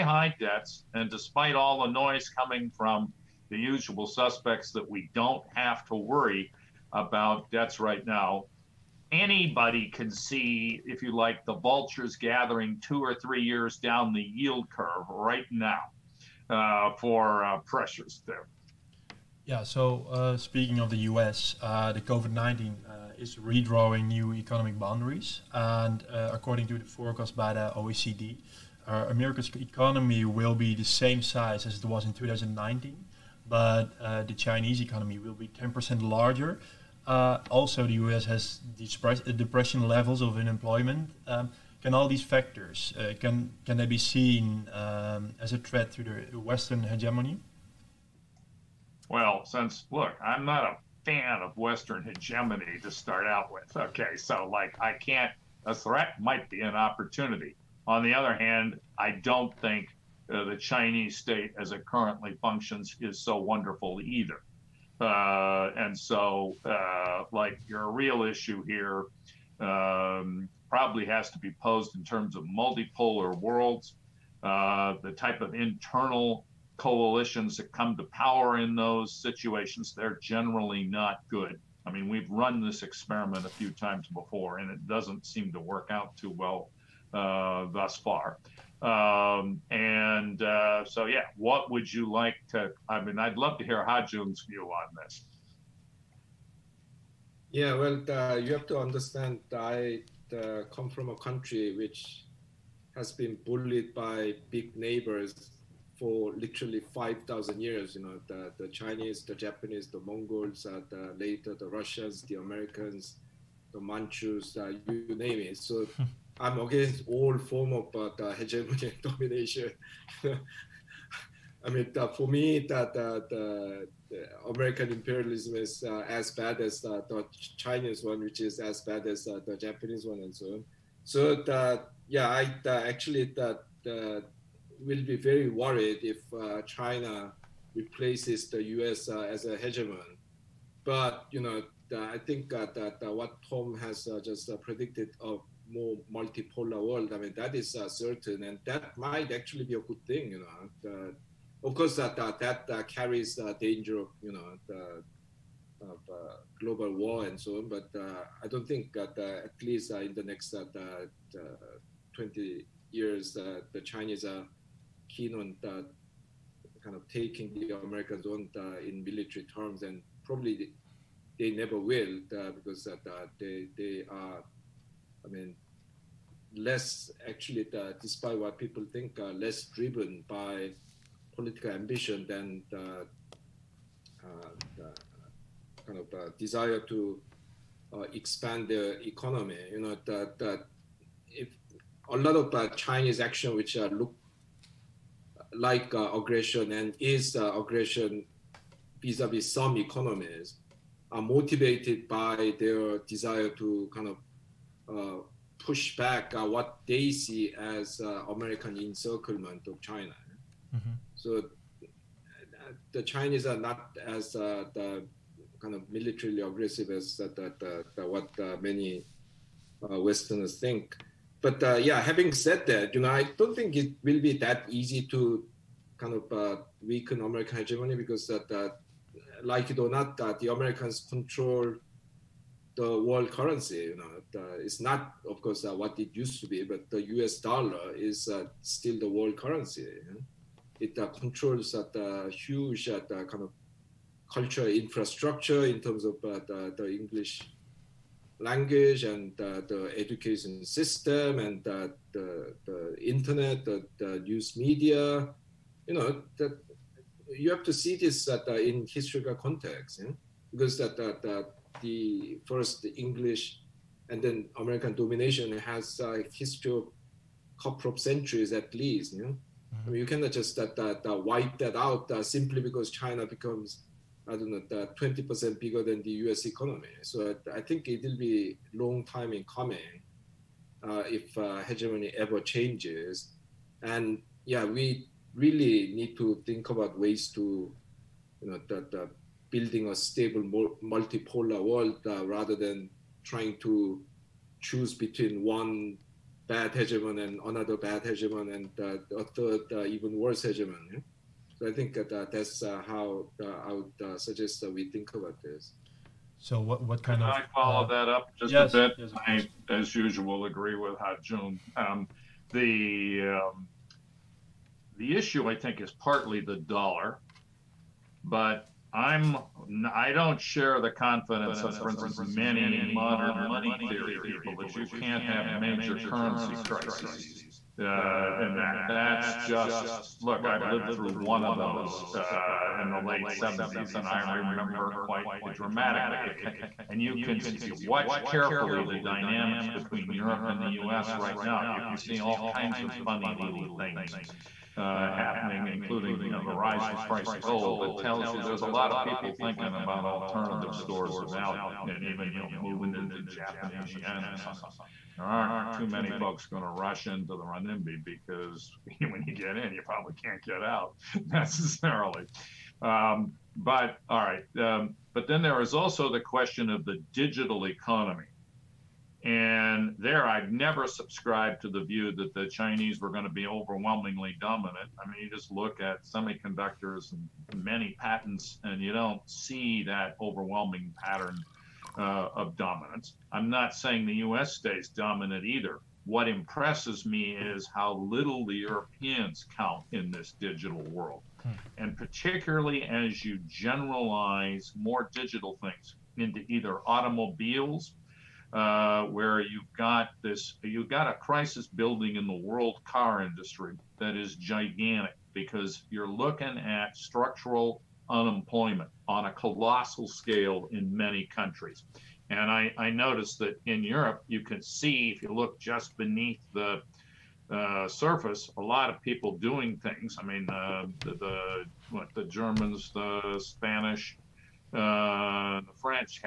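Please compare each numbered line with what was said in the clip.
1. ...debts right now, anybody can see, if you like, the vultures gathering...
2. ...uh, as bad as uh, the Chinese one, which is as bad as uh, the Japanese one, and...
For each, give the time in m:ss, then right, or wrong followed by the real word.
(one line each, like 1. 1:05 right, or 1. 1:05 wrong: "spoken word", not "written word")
1. 0:07 right
2. 2:05 right.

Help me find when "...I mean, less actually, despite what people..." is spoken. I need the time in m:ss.
2:55.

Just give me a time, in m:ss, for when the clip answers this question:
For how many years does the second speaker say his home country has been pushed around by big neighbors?
1:46.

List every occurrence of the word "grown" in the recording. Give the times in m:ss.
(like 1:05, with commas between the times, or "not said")
not said.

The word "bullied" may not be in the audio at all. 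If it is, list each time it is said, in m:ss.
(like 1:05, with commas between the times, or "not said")
1:43.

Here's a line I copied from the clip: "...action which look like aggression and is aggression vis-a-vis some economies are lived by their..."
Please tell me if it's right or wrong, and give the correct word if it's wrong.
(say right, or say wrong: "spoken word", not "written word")
wrong: "motivated", not "lived".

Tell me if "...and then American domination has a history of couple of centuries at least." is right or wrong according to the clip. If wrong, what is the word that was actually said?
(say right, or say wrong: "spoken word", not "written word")
right.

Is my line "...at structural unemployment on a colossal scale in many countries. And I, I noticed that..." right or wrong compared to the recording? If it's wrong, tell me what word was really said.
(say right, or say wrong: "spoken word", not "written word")
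right.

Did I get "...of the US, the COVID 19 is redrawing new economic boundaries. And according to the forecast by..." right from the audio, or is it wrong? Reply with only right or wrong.
right.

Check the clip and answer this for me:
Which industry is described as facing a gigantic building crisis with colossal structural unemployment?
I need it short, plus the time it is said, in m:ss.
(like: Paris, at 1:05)
car industry, at 6:42.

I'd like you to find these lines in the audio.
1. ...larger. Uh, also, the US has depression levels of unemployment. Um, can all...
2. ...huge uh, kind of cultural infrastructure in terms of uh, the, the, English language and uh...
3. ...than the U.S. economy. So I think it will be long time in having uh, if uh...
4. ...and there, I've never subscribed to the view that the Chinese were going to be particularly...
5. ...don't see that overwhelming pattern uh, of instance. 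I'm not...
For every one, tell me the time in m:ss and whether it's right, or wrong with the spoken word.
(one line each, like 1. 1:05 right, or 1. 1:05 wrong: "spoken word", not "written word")
1. 0:36 right
2. 4:02 right
3. 4:35 wrong: "coming", not "having"
4. 6:09 wrong: "overwhelmingly", not "particularly"
5. 6:18 wrong: "dominance", not "instance".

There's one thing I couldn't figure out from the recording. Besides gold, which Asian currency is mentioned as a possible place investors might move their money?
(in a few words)
Japanese yen.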